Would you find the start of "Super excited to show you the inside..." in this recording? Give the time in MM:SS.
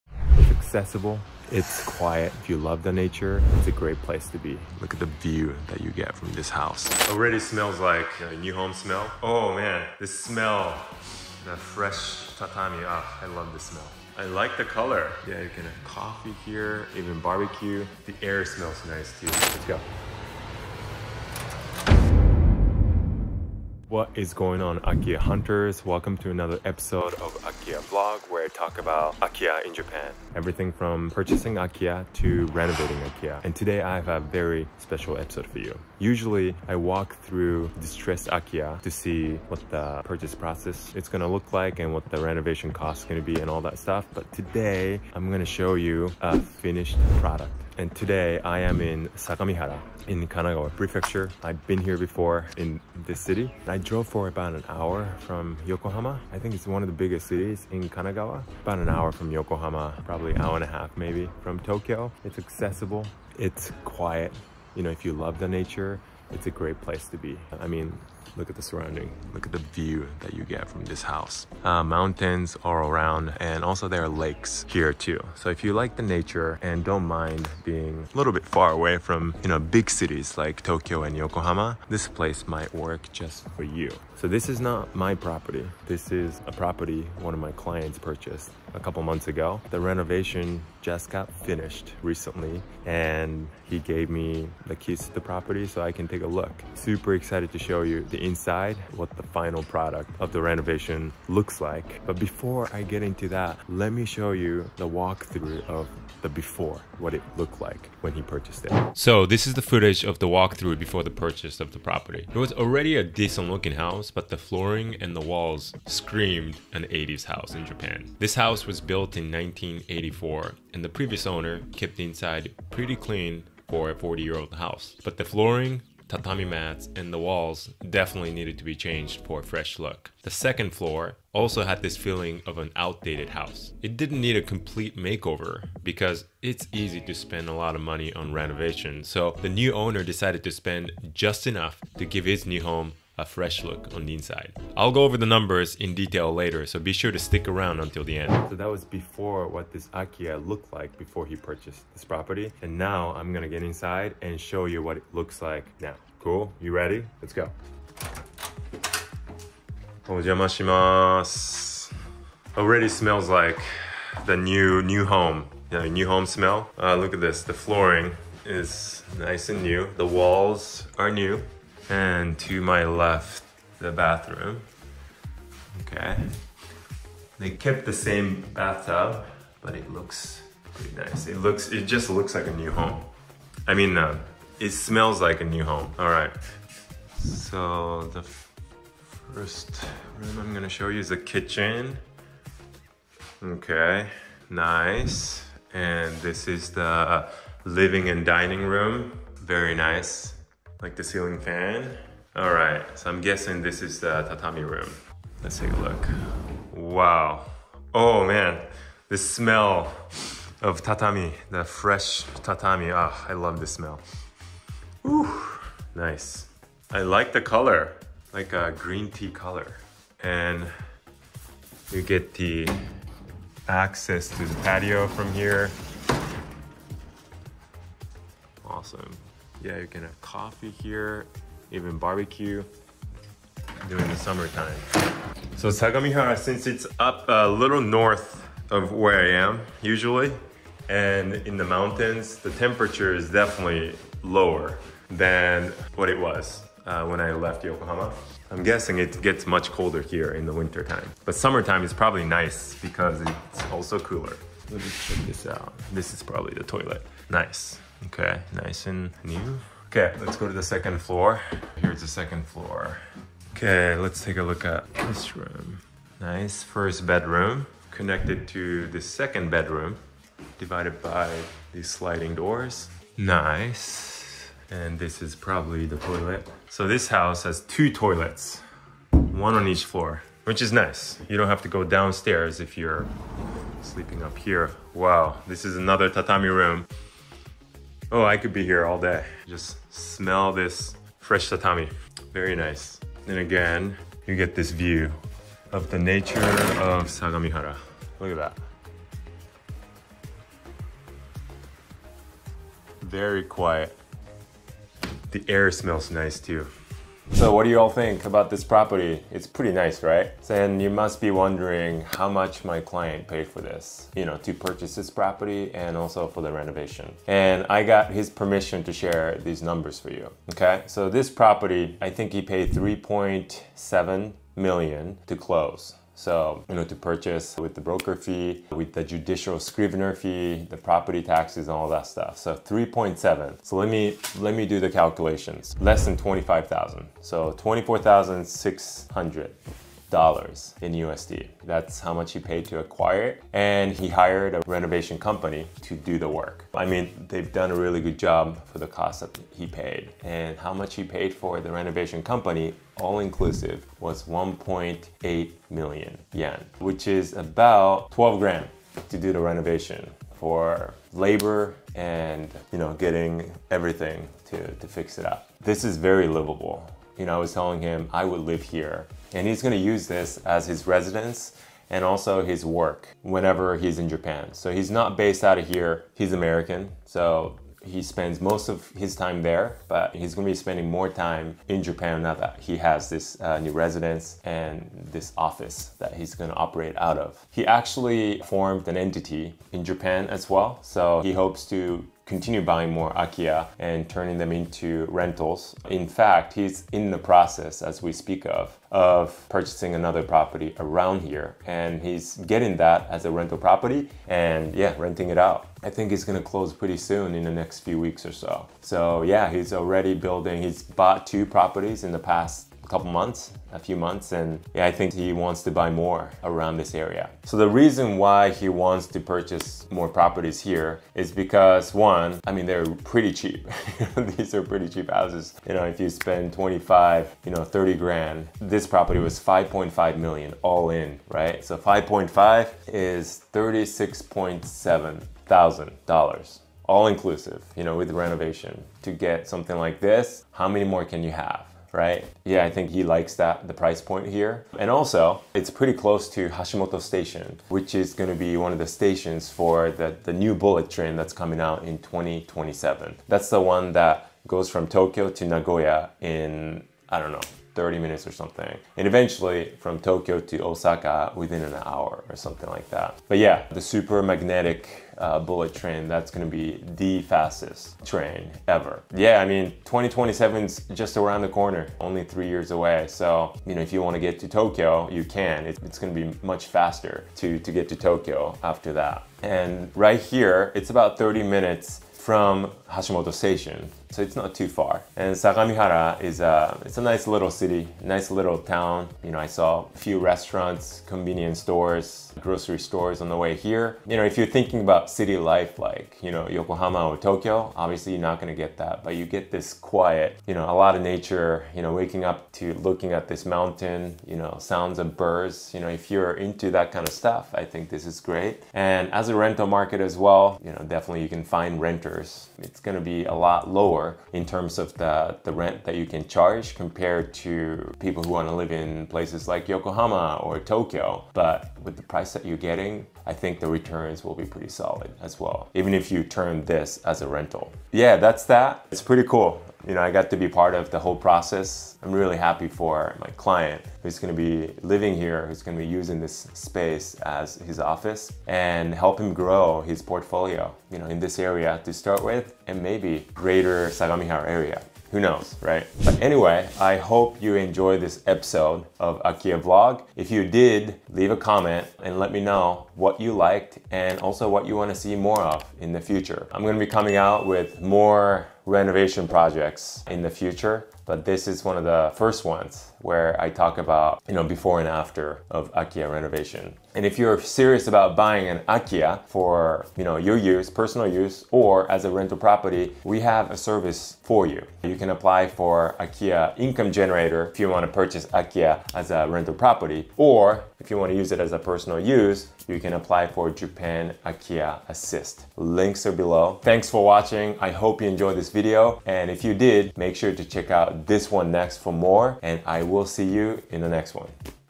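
01:36.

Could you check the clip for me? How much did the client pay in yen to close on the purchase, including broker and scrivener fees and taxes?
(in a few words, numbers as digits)
3.7 million yen.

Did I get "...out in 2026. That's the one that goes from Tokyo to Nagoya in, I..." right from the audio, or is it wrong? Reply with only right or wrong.
wrong.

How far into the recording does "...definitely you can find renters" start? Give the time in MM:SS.
08:30.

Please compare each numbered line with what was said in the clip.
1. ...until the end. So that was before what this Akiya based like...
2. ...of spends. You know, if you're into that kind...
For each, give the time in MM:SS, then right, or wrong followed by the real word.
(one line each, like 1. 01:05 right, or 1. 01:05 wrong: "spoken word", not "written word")
1. 02:27 wrong: "looked", not "based"
2. 08:24 wrong: "birds", not "spends".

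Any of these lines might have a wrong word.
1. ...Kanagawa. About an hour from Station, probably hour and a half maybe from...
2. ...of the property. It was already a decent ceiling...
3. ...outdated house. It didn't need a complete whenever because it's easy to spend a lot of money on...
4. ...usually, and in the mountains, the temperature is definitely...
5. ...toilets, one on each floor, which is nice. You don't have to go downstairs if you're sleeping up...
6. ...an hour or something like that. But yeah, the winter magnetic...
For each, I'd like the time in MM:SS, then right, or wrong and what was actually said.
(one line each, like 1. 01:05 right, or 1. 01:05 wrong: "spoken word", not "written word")
1. 00:57 wrong: "Yokohama", not "Station"
2. 01:51 wrong: "looking", not "ceiling"
3. 02:12 wrong: "makeover", not "whenever"
4. 03:59 right
5. 04:37 right
6. 07:41 wrong: "super", not "winter".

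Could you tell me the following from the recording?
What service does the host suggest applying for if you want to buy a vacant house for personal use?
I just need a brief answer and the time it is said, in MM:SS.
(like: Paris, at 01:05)
Japan Akiya Assist, at 09:43.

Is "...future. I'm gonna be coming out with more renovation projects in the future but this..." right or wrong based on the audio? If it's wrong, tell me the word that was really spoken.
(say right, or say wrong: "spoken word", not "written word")
right.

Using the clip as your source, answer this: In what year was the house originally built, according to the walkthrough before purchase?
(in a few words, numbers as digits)
1984.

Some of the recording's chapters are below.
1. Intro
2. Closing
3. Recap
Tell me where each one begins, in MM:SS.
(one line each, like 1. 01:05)
1. 00:23
2. 09:06
3. 05:07.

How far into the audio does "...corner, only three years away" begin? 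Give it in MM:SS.
07:51.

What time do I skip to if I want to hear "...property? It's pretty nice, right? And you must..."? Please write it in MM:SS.
05:08.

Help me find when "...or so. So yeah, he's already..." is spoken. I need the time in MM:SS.
06:48.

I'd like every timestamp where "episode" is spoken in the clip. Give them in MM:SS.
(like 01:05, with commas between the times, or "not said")
00:26, 00:35, 09:08.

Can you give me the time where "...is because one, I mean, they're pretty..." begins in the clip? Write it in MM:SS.
07:01.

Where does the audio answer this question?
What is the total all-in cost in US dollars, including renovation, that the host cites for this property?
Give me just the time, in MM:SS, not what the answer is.
07:13.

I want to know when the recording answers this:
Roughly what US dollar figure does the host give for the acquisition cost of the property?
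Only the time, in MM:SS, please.
05:37.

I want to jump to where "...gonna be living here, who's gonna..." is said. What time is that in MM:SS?
08:54.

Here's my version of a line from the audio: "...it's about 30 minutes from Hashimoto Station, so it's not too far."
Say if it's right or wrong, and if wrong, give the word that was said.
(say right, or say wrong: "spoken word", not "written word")
right.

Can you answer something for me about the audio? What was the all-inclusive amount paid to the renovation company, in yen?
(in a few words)
1.8 million yen.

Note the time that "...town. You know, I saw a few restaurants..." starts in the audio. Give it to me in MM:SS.
08:08.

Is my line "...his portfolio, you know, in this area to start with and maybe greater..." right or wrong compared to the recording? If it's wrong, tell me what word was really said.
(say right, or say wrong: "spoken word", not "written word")
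right.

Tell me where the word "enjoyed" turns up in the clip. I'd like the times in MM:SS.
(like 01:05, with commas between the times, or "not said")
09:07, 09:48.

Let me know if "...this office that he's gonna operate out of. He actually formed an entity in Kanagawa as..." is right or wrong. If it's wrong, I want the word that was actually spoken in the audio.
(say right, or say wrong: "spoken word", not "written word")
wrong: "Japan", not "Kanagawa".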